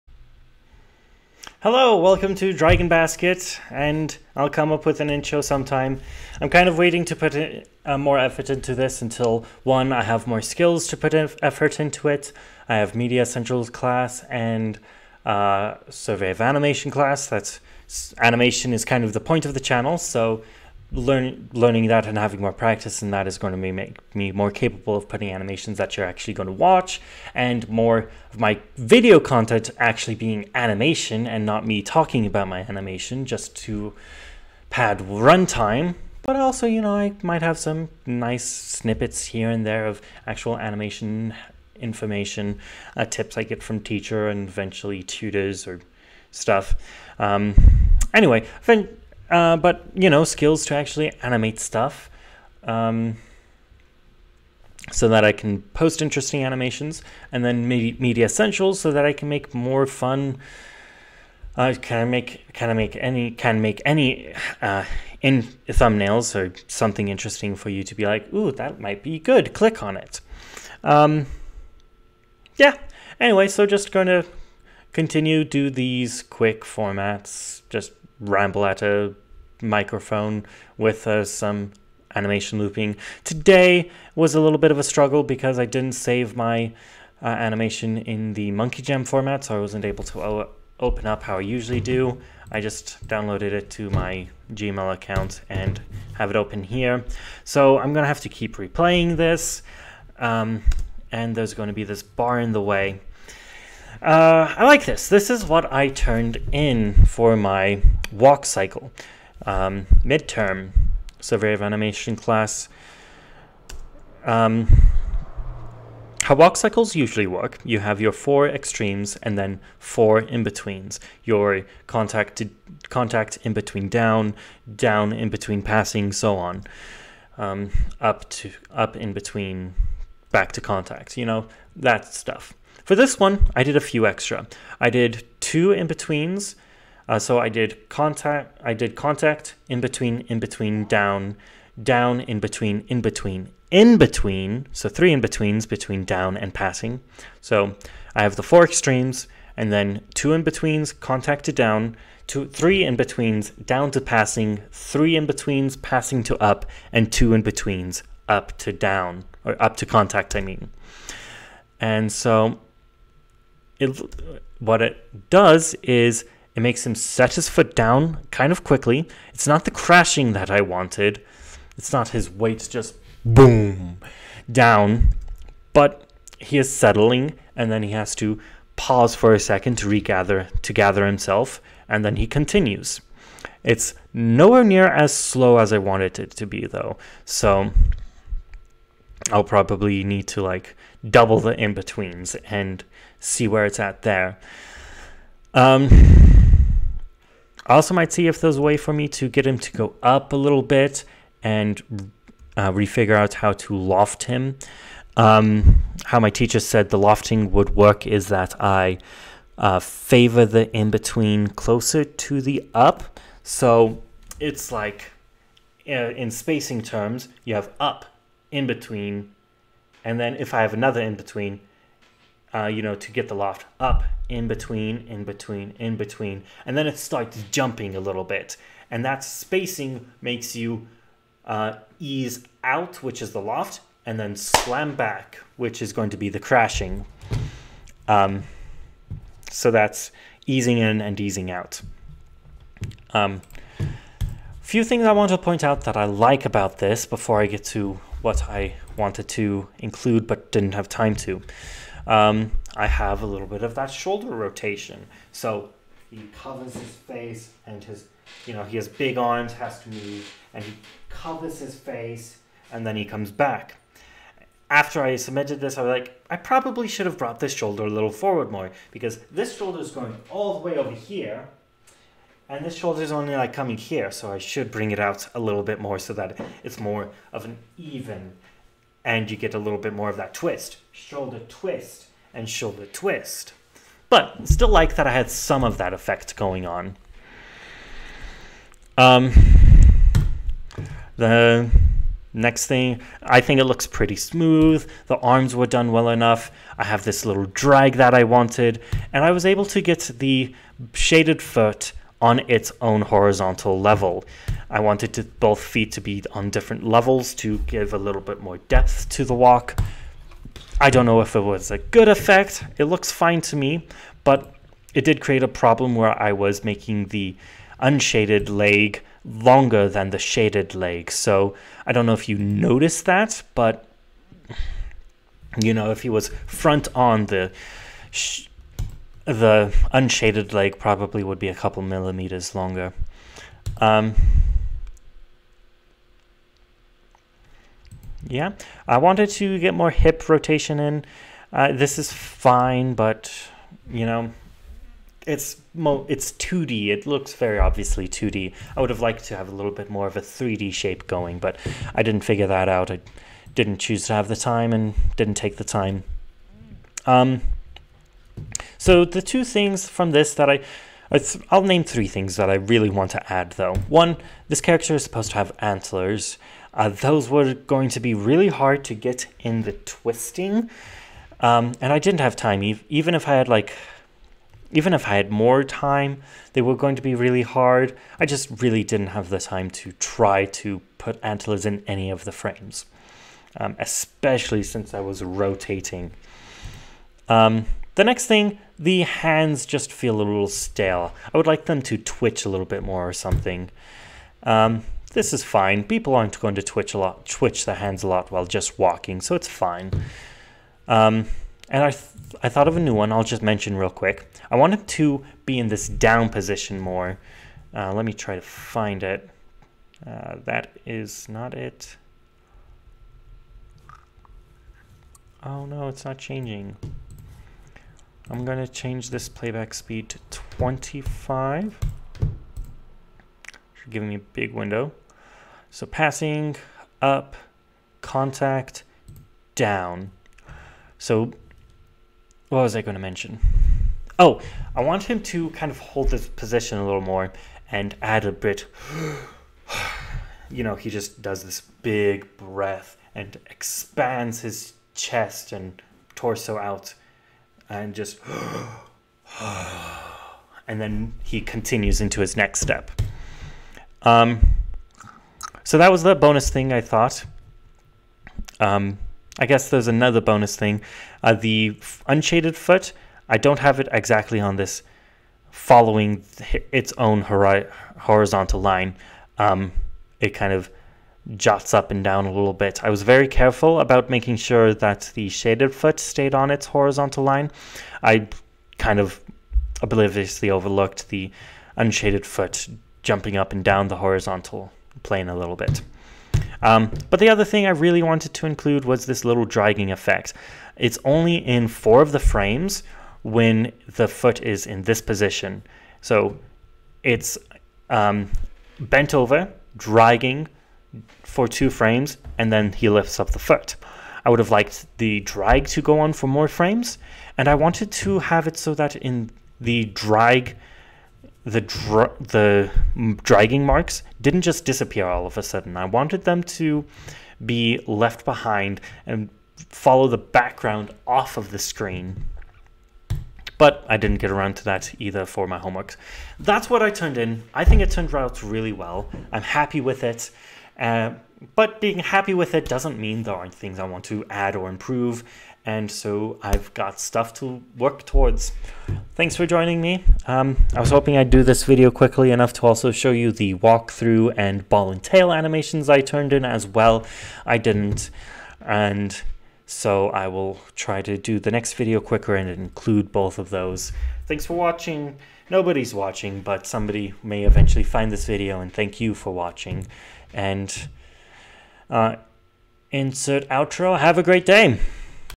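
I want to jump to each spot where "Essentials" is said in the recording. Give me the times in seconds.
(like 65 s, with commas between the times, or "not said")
13 s, 58 s.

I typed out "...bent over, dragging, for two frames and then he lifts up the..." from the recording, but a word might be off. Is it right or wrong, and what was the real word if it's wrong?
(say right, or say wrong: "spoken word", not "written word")
right.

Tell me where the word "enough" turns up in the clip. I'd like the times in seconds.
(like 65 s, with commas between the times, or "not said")
296 s, 542 s.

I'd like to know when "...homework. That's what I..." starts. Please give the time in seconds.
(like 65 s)
525 s.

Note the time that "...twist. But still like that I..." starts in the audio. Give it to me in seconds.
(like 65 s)
282 s.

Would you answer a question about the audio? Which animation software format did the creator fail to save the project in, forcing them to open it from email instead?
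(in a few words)
MonkeyJam.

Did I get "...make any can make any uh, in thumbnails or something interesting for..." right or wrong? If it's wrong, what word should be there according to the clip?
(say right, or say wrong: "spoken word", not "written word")
right.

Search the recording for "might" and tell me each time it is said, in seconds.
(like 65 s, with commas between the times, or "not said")
37 s, 68 s, 197 s.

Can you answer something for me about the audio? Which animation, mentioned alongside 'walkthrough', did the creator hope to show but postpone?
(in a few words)
Ball and tail.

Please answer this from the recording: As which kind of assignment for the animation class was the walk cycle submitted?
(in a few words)
Midterm.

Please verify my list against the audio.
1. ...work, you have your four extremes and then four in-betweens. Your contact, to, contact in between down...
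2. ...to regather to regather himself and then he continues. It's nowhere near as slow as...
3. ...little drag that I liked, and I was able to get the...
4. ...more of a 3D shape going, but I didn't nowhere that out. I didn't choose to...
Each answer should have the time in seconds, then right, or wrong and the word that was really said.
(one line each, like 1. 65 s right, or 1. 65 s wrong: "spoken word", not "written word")
1. 117 s right
2. 179 s wrong: "gather", not "regather"
3. 297 s wrong: "wanted", not "liked"
4. 349 s wrong: "figure", not "nowhere".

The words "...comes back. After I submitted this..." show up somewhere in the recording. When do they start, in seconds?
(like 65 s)
263 s.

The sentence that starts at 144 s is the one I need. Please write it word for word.
So three in betweens between down and passing.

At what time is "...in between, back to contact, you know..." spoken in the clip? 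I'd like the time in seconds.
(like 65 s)
128 s.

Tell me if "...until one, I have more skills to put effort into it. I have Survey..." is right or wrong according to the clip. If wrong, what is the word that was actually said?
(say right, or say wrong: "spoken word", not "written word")
wrong: "Media", not "Survey".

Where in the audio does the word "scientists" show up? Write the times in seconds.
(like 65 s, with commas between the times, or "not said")
not said.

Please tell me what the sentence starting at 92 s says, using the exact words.
I just downloaded it to my Gmail account and have it open here.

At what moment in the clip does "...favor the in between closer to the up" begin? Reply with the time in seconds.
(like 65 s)
209 s.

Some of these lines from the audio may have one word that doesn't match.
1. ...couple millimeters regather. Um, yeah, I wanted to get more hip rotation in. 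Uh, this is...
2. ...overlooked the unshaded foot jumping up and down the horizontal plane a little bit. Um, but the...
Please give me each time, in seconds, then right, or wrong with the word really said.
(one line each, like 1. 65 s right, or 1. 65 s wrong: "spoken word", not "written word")
1. 331 s wrong: "longer", not "regather"
2. 480 s right.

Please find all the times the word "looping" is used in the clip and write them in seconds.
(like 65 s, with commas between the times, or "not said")
82 s.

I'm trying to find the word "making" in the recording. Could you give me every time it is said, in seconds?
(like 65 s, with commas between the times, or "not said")
316 s, 474 s.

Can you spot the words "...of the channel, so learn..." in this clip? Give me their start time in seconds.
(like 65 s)
19 s.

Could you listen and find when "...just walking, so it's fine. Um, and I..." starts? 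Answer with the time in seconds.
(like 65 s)
398 s.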